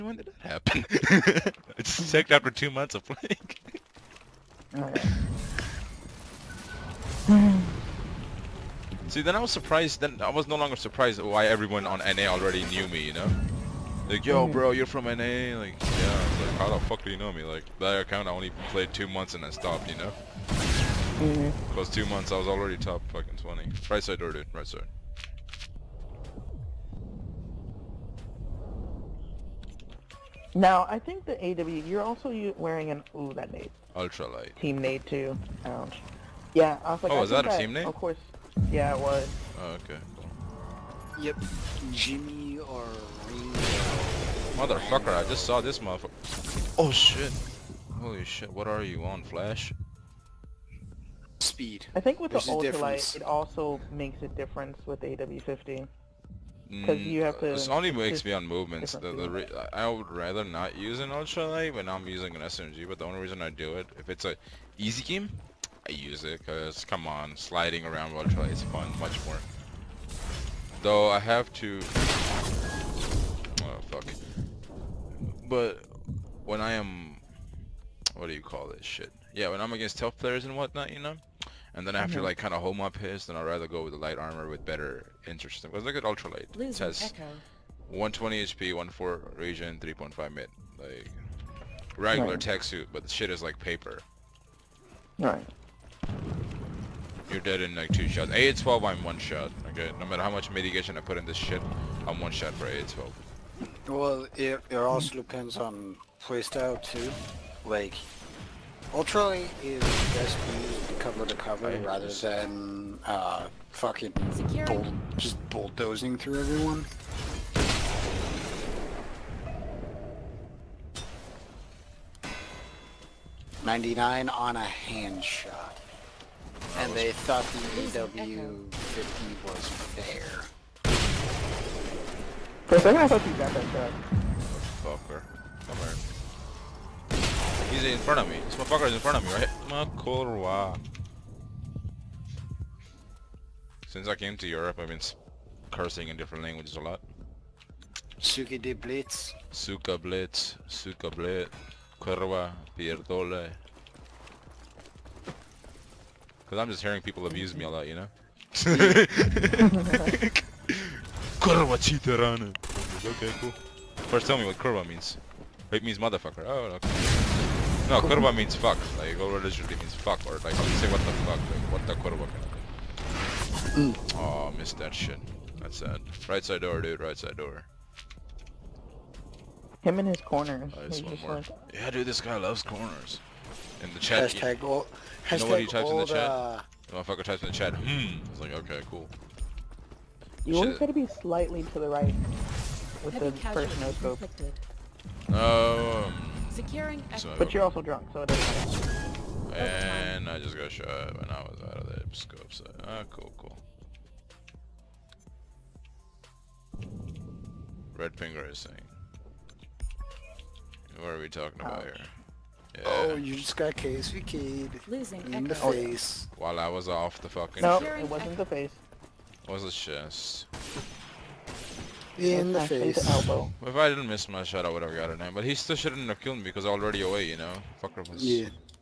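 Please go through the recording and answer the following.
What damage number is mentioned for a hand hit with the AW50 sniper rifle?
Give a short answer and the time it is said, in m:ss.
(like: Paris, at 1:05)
99, at 2:03.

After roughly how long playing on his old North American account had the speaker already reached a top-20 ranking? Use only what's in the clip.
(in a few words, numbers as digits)
2 months.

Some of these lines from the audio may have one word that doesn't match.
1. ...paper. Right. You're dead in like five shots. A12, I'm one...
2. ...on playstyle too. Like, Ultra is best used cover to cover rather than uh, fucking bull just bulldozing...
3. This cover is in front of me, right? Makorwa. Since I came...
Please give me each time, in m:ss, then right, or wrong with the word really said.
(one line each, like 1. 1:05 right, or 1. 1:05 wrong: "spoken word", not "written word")
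1. 1:33 wrong: "two", not "five"
2. 1:45 right
3. 2:18 wrong: "motherfucker", not "cover".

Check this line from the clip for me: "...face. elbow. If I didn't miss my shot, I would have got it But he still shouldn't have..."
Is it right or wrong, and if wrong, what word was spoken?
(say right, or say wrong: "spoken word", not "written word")
right.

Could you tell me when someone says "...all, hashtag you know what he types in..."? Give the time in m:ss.
3:04.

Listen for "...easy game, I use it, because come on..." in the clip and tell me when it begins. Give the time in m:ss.
1:04.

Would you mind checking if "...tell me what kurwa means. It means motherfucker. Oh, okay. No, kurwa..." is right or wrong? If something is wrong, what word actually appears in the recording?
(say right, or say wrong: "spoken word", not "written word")
right.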